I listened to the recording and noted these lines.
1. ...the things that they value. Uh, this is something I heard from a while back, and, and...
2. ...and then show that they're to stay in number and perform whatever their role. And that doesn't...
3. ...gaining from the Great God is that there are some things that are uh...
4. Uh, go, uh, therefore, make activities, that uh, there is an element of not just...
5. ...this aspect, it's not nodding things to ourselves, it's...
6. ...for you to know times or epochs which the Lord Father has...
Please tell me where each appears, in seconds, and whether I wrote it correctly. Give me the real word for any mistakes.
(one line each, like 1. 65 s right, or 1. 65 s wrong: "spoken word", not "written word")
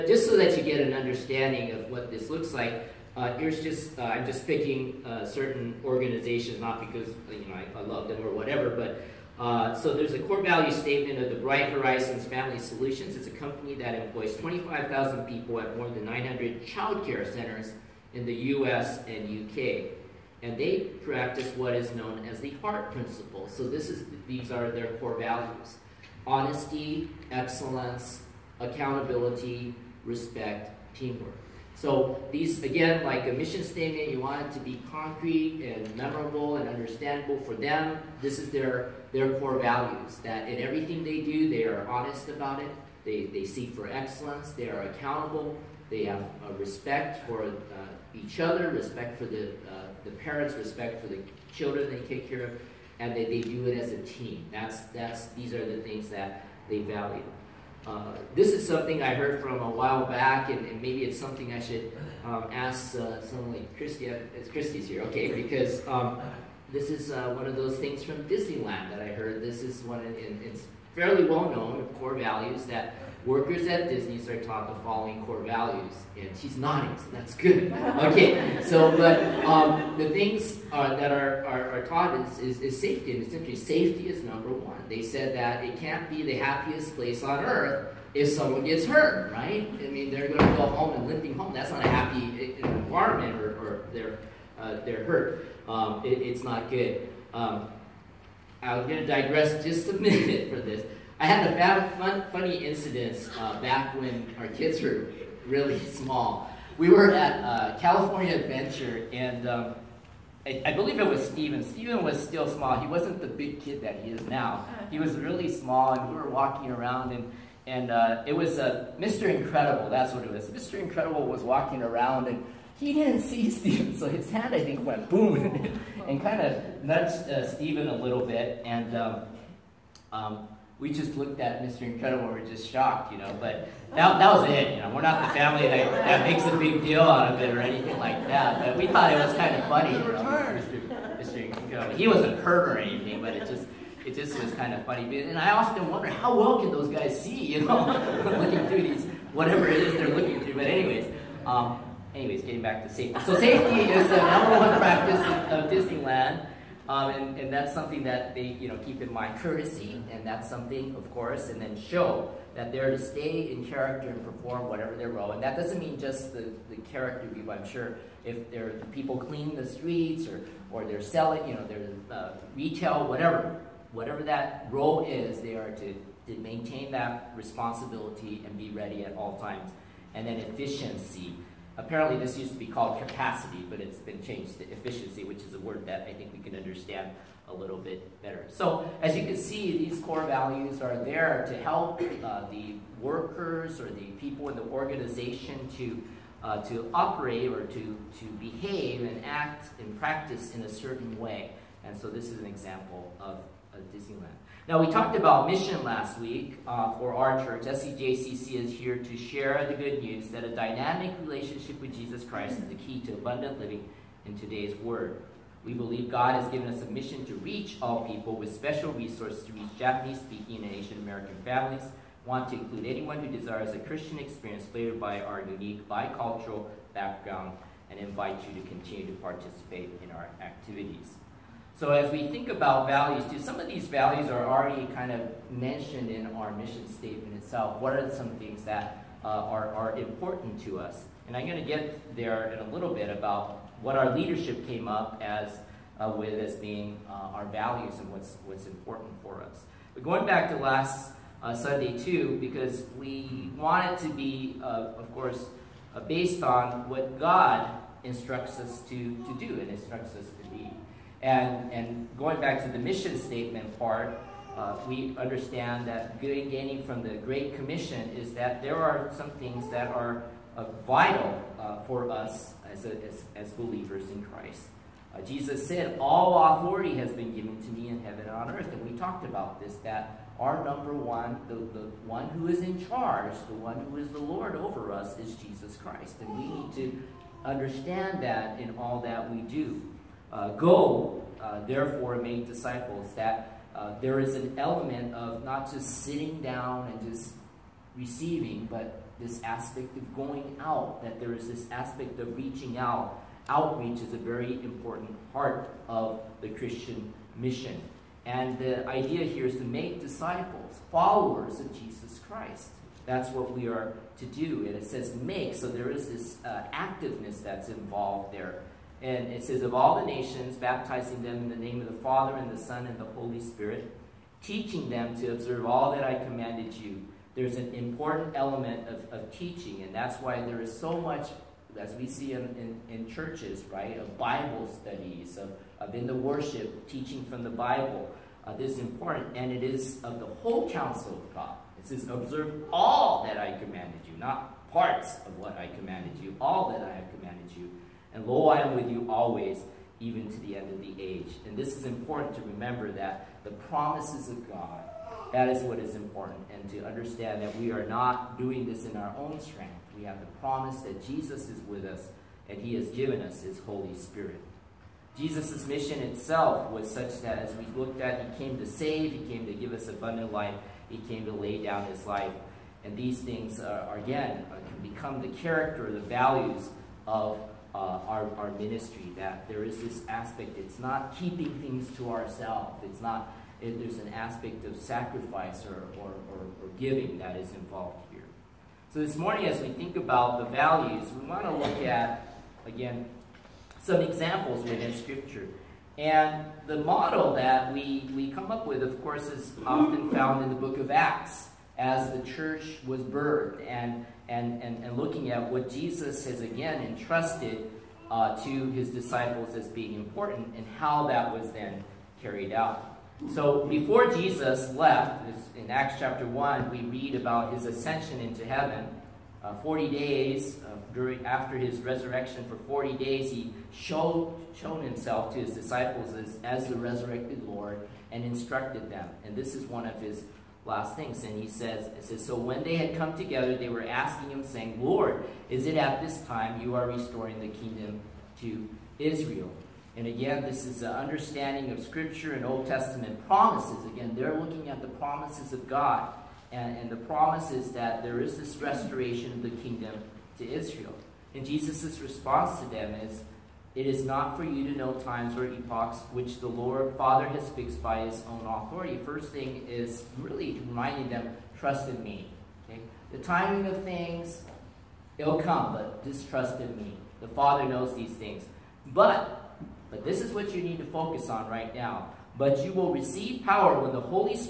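1. 55 s right
2. 161 s wrong: "character", not "number"
3. 266 s wrong: "Commission", not "God"
4. 290 s wrong: "disciples", not "activities"
5. 379 s wrong: "keeping", not "nodding"
6. 454 s right.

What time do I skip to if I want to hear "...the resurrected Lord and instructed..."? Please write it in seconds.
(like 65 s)
426 s.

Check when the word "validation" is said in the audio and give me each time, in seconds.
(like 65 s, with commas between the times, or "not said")
not said.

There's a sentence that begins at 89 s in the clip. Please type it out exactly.
I mean, they're going to go home and limping home.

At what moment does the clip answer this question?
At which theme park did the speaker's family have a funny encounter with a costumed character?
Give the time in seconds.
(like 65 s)
107 s.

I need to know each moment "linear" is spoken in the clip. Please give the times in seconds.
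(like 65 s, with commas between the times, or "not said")
not said.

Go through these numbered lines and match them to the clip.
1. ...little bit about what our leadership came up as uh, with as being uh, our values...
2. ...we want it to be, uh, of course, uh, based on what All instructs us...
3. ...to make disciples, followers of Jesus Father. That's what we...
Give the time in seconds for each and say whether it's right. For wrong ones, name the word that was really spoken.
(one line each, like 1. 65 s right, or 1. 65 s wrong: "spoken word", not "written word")
1. 242 s right
2. 252 s wrong: "God", not "All"
3. 309 s wrong: "Christ", not "Father".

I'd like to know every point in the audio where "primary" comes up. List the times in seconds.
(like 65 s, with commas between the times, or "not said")
not said.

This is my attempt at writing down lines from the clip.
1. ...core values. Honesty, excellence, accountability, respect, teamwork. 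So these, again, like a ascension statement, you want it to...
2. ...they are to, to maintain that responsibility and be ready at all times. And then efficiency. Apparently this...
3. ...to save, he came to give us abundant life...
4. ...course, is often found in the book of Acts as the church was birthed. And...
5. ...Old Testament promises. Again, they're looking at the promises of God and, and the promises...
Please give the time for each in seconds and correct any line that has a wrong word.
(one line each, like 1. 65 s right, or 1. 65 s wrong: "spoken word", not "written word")
1. 24 s wrong: "mission", not "ascension"
2. 175 s right
3. 368 s right
4. 399 s right
5. 442 s right.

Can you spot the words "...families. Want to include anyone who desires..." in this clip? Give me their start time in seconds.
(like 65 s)
221 s.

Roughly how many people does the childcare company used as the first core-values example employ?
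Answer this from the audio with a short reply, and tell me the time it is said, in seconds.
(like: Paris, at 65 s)
25,000, at 14 s.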